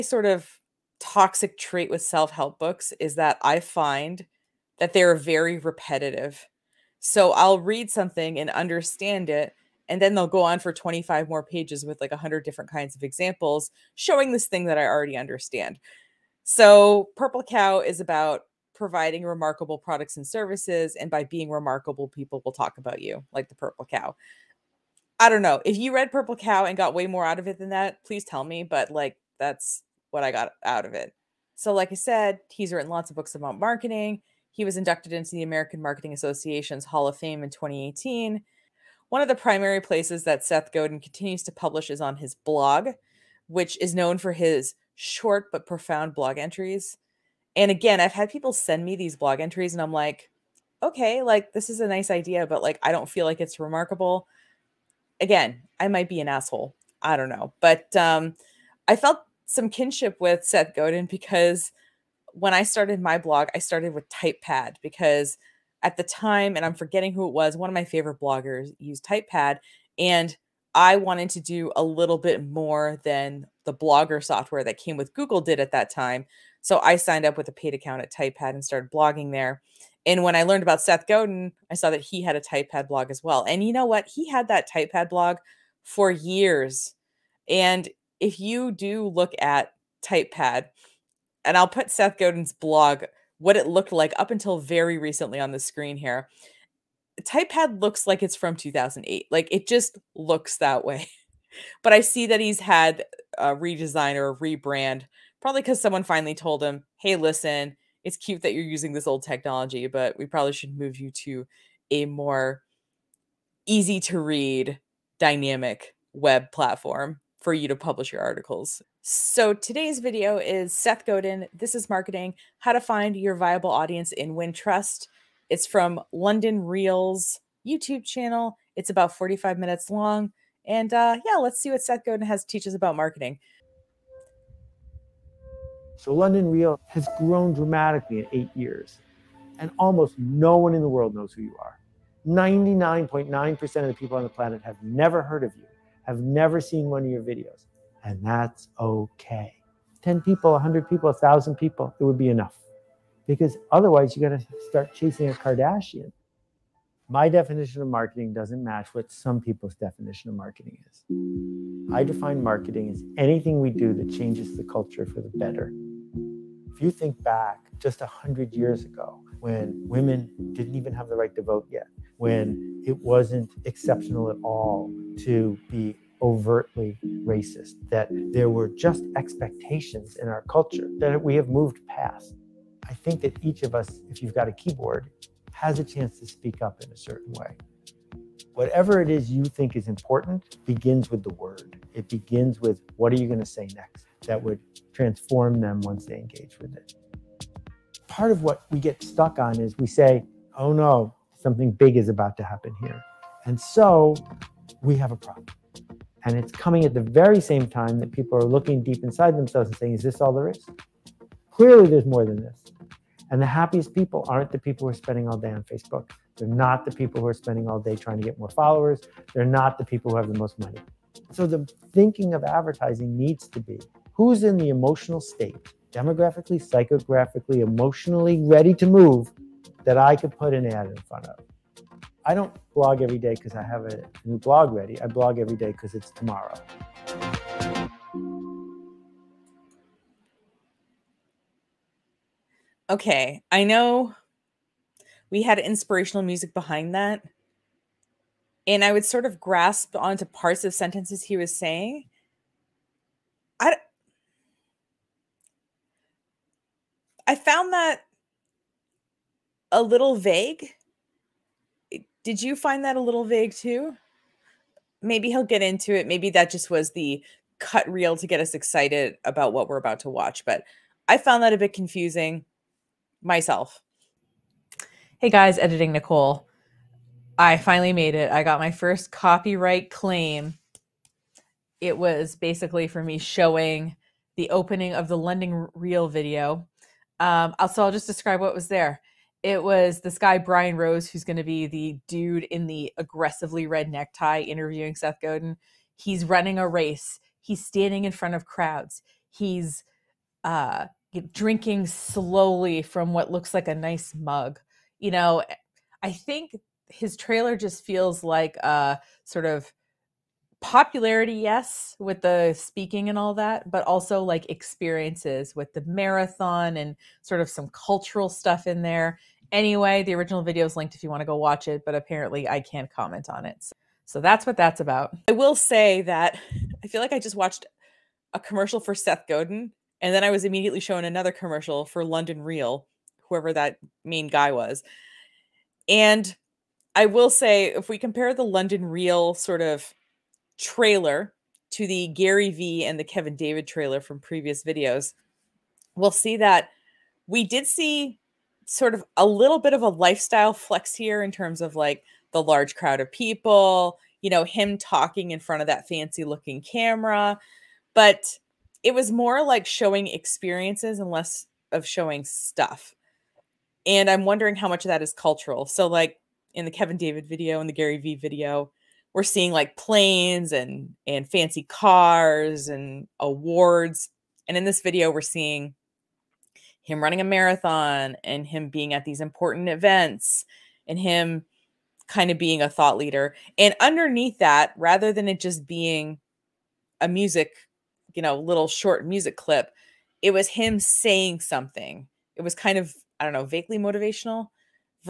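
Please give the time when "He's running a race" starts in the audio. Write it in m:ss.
4:55.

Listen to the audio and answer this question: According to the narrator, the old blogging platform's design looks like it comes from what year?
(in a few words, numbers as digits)
2008.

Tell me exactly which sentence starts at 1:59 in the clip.
So today's video is Seth Godin.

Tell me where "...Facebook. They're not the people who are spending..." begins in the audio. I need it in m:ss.
3:35.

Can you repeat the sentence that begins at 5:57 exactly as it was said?
But it was more like showing experiences and less of showing stuff.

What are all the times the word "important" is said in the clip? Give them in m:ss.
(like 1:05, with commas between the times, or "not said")
3:09, 6:19.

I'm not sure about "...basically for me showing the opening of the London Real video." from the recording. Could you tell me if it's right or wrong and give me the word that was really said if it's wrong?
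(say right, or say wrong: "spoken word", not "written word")
right.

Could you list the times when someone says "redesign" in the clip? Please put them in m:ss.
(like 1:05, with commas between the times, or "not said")
1:43.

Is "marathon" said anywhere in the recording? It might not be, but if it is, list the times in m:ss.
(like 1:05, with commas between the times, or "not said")
5:15, 6:17.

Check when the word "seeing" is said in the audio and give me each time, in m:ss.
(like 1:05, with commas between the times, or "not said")
6:09, 6:15.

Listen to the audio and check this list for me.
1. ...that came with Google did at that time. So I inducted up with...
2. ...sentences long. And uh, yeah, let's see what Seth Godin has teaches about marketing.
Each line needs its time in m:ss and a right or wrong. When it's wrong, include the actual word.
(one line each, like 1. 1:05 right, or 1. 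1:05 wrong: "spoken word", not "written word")
1. 1:14 wrong: "signed", not "inducted"
2. 2:09 wrong: "minutes", not "sentences".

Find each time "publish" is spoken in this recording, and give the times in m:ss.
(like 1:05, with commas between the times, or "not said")
0:41, 1:57.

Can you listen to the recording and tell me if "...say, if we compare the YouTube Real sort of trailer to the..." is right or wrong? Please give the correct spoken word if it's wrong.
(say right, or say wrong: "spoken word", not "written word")
wrong: "London", not "YouTube".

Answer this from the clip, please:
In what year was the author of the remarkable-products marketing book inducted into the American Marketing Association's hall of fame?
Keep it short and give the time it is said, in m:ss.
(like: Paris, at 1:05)
2018, at 0:37.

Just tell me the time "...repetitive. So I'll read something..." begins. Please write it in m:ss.
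0:05.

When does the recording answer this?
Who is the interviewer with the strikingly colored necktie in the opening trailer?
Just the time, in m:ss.
4:50.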